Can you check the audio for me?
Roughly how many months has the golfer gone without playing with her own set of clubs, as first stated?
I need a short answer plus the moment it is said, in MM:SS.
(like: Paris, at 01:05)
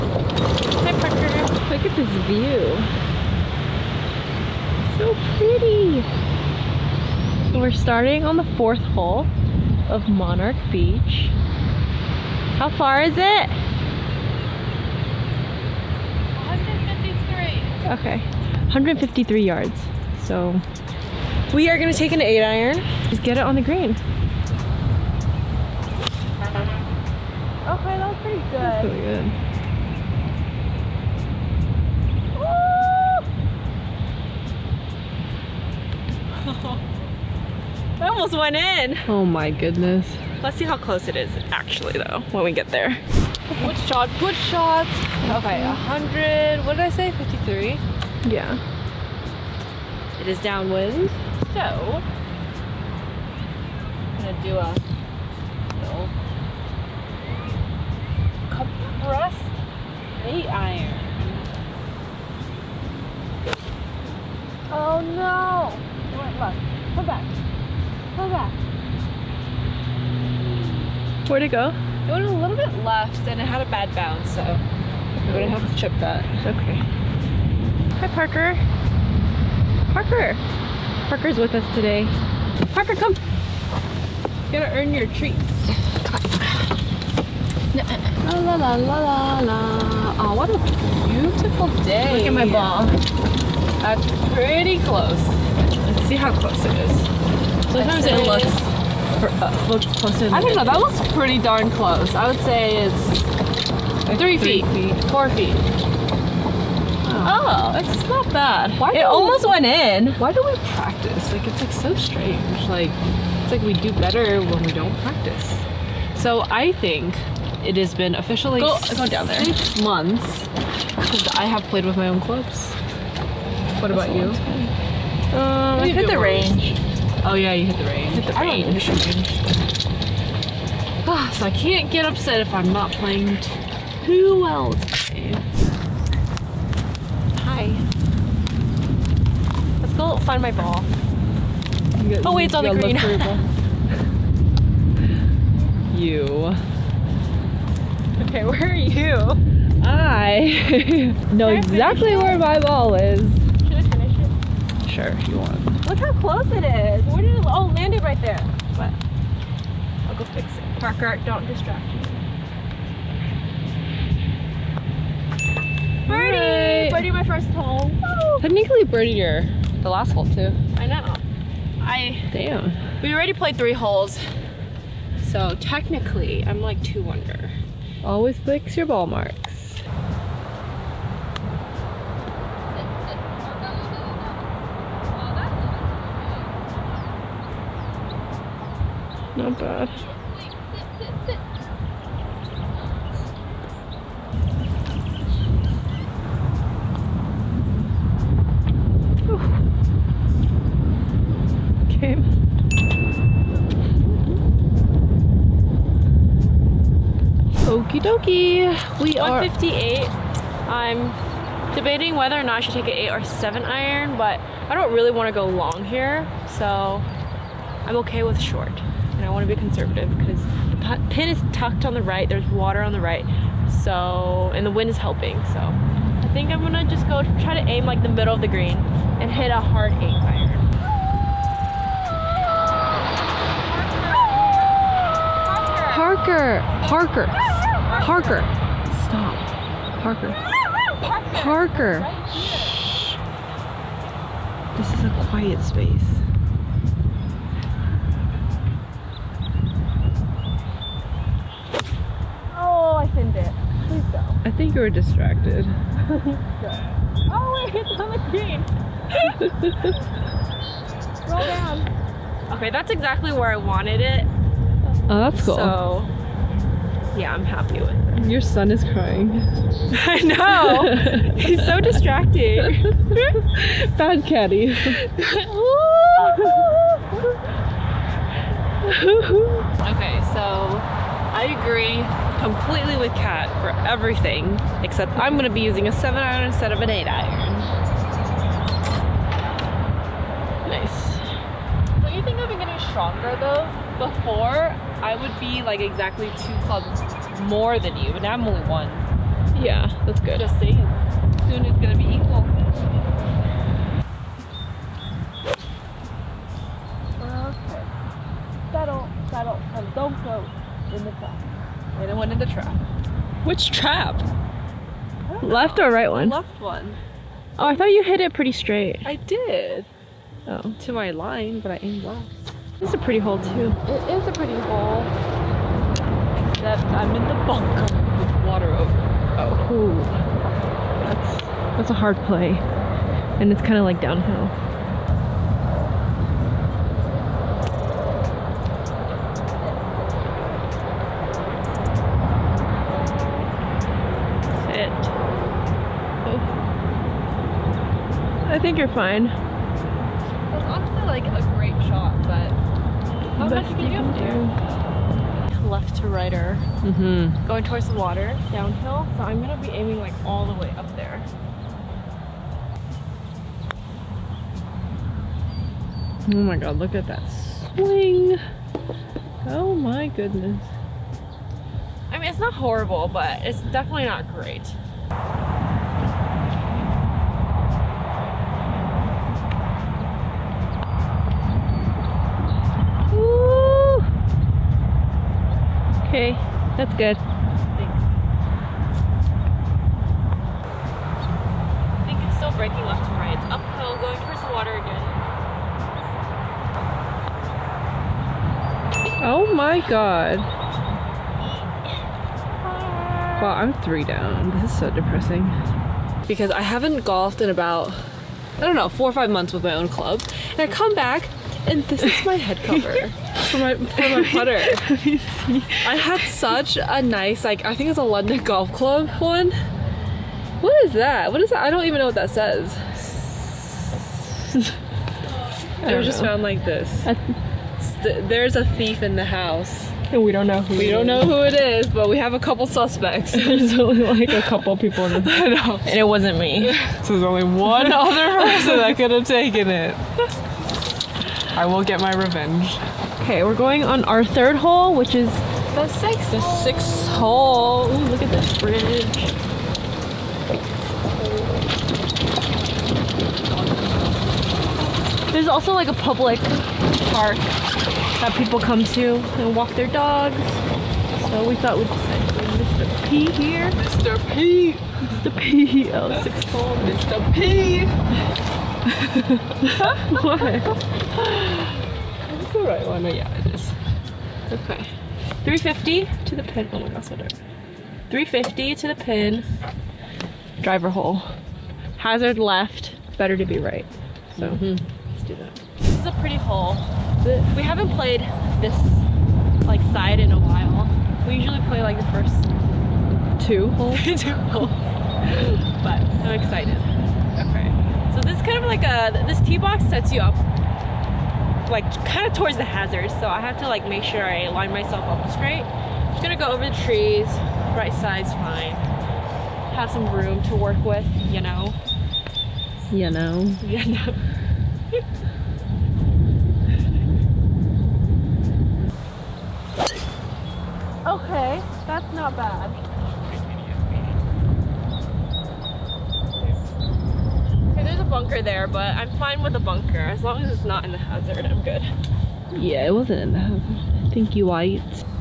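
6, at 01:59.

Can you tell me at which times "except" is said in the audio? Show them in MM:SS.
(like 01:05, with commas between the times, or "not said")
04:44, 05:26.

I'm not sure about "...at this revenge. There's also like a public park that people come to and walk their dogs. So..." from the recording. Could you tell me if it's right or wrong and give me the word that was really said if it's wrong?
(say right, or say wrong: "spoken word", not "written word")
wrong: "bridge", not "revenge".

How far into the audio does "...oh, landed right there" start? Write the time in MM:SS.
02:37.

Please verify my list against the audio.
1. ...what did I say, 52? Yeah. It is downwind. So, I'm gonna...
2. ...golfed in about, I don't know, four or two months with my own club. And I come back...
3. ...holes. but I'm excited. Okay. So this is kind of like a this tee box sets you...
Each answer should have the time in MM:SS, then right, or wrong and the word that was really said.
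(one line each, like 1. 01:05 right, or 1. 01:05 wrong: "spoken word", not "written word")
1. 00:46 wrong: "53", not "52"
2. 06:47 wrong: "five", not "two"
3. 08:14 right.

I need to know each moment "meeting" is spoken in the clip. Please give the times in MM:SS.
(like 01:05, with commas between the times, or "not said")
not said.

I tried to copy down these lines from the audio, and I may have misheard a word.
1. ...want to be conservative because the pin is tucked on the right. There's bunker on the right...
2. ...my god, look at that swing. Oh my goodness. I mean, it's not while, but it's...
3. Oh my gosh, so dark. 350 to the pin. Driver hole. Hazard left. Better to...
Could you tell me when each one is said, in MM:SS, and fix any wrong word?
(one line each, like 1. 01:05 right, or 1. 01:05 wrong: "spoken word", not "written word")
1. 03:39 wrong: "water", not "bunker"
2. 06:06 wrong: "horrible", not "while"
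3. 07:56 right.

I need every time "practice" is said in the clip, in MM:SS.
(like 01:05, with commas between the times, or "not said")
01:50, 01:54.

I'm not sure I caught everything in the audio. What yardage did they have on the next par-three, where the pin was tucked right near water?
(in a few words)
158.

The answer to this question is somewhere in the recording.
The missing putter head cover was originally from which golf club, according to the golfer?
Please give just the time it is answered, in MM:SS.
06:58.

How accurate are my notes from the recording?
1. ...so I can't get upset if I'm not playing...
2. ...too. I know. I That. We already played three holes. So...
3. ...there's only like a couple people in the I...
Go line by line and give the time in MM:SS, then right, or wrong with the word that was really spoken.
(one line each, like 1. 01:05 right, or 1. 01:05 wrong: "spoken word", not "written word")
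1. 02:11 right
2. 02:50 wrong: "Damn", not "That"
3. 07:13 right.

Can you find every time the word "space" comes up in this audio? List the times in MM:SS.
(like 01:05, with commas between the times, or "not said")
04:05.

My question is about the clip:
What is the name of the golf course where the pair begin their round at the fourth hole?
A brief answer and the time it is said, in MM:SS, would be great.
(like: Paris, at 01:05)
Monarch Beach, at 00:10.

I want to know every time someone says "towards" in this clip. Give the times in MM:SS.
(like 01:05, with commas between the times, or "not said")
05:57, 06:34, 08:22.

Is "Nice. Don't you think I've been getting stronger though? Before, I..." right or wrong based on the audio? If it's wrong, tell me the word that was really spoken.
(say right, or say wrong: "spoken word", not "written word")
right.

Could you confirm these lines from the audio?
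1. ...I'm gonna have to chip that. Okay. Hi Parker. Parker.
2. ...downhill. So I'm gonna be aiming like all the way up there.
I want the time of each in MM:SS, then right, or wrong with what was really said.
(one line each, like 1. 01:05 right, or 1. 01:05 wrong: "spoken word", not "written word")
1. 01:14 right
2. 05:58 right.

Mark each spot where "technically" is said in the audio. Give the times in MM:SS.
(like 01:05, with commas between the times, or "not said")
02:48, 02:55.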